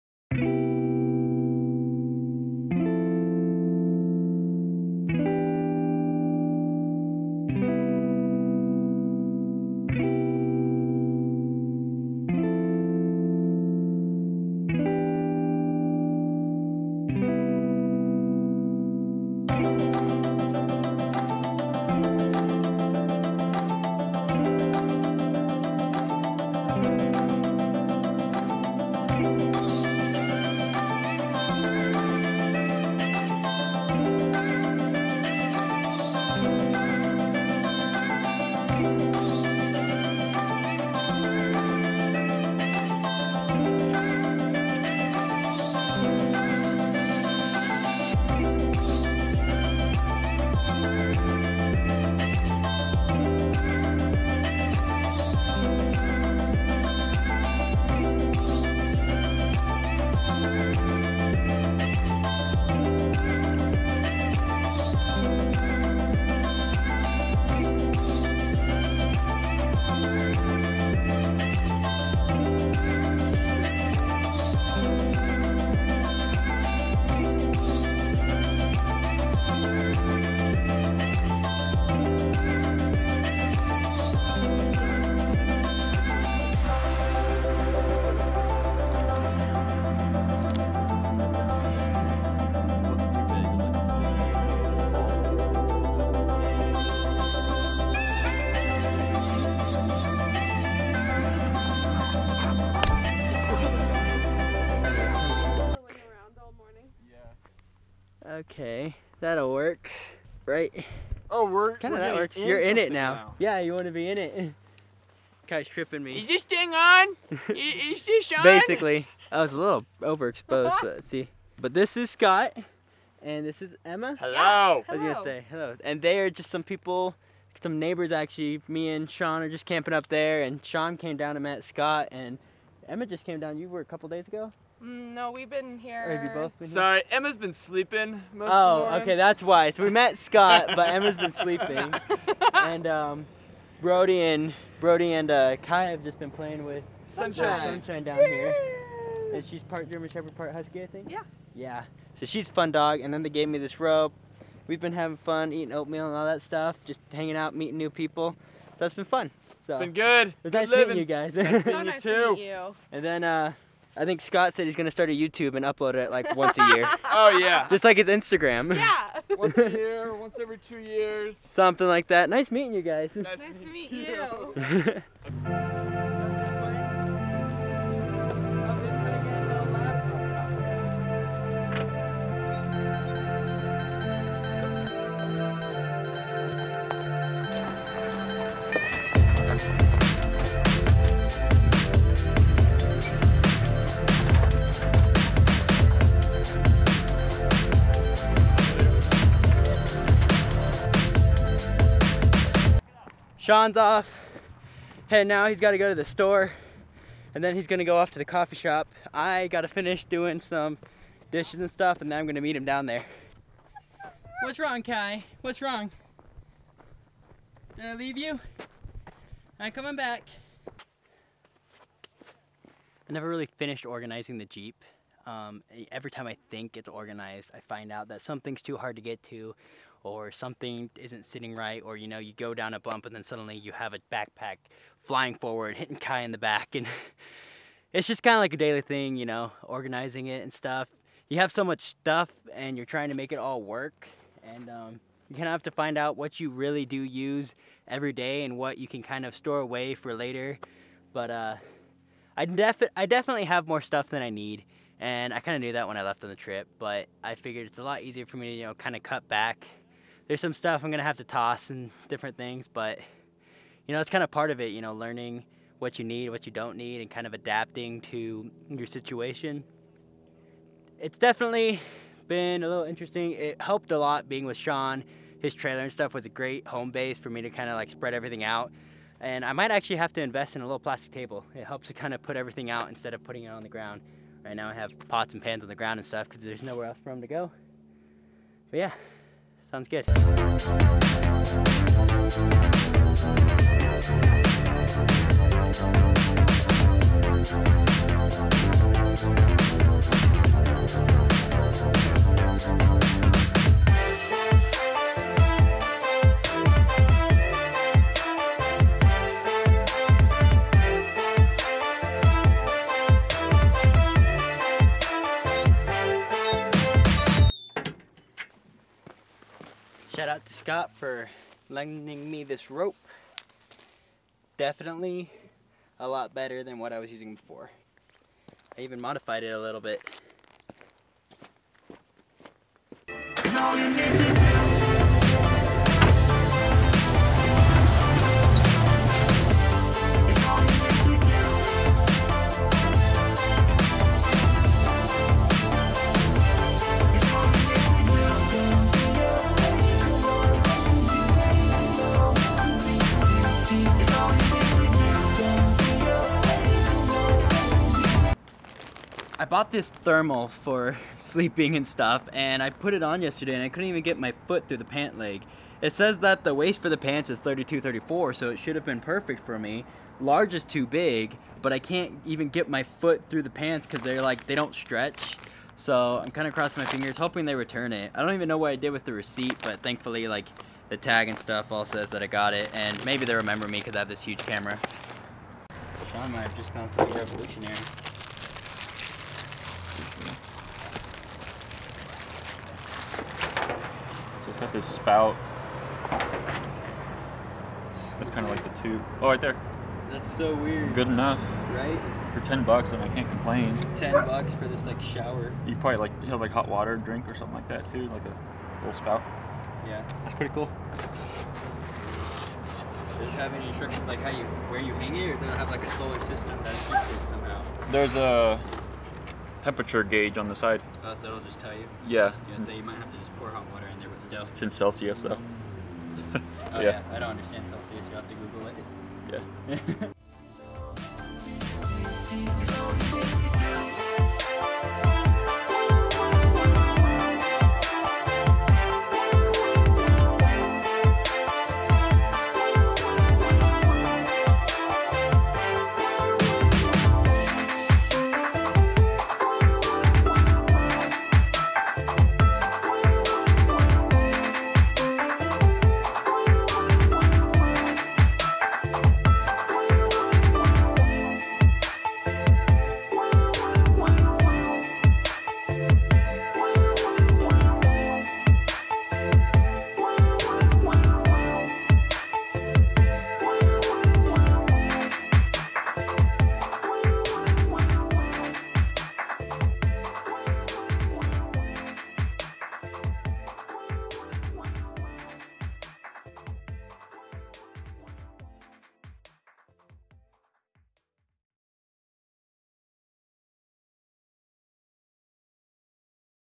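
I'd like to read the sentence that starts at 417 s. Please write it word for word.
There's a temperature gauge on the side.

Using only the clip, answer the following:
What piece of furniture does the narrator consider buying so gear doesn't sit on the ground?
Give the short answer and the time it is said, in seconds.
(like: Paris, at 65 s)
plastic table, at 280 s.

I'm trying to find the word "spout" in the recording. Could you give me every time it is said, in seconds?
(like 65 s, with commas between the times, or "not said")
394 s, 408 s.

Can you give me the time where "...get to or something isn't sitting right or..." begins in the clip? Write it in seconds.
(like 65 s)
229 s.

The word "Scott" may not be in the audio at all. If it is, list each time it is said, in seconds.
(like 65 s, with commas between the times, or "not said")
122 s, 131 s, 140 s, 164 s, 320 s.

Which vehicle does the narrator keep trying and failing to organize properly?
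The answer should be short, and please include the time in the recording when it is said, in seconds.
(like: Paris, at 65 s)
Jeep, at 224 s.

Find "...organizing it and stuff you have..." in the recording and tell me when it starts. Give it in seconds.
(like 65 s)
239 s.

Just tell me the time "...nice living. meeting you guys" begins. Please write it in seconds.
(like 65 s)
160 s.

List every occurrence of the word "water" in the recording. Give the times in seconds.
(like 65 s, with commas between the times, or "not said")
406 s, 423 s.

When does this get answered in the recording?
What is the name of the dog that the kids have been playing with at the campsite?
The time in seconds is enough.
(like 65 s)
147 s.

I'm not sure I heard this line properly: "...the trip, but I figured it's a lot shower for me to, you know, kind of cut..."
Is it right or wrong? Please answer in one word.
wrong.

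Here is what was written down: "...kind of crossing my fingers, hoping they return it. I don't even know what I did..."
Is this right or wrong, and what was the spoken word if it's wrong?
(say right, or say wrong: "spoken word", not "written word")
right.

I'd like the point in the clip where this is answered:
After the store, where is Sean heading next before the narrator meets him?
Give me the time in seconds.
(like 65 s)
208 s.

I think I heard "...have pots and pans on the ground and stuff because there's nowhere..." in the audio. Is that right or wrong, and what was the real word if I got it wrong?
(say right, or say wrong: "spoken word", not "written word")
right.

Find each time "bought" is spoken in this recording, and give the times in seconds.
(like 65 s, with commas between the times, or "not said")
359 s.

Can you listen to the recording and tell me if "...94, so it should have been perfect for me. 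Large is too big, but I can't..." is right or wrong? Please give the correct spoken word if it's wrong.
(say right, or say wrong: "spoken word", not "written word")
wrong: "34", not "94".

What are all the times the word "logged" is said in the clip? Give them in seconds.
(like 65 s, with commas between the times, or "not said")
not said.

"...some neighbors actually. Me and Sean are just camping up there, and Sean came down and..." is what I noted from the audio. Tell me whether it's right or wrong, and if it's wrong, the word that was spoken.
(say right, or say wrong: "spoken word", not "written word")
right.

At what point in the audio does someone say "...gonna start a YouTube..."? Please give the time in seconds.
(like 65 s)
164 s.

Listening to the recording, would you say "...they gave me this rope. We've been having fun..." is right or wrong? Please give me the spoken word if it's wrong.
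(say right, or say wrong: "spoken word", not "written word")
right.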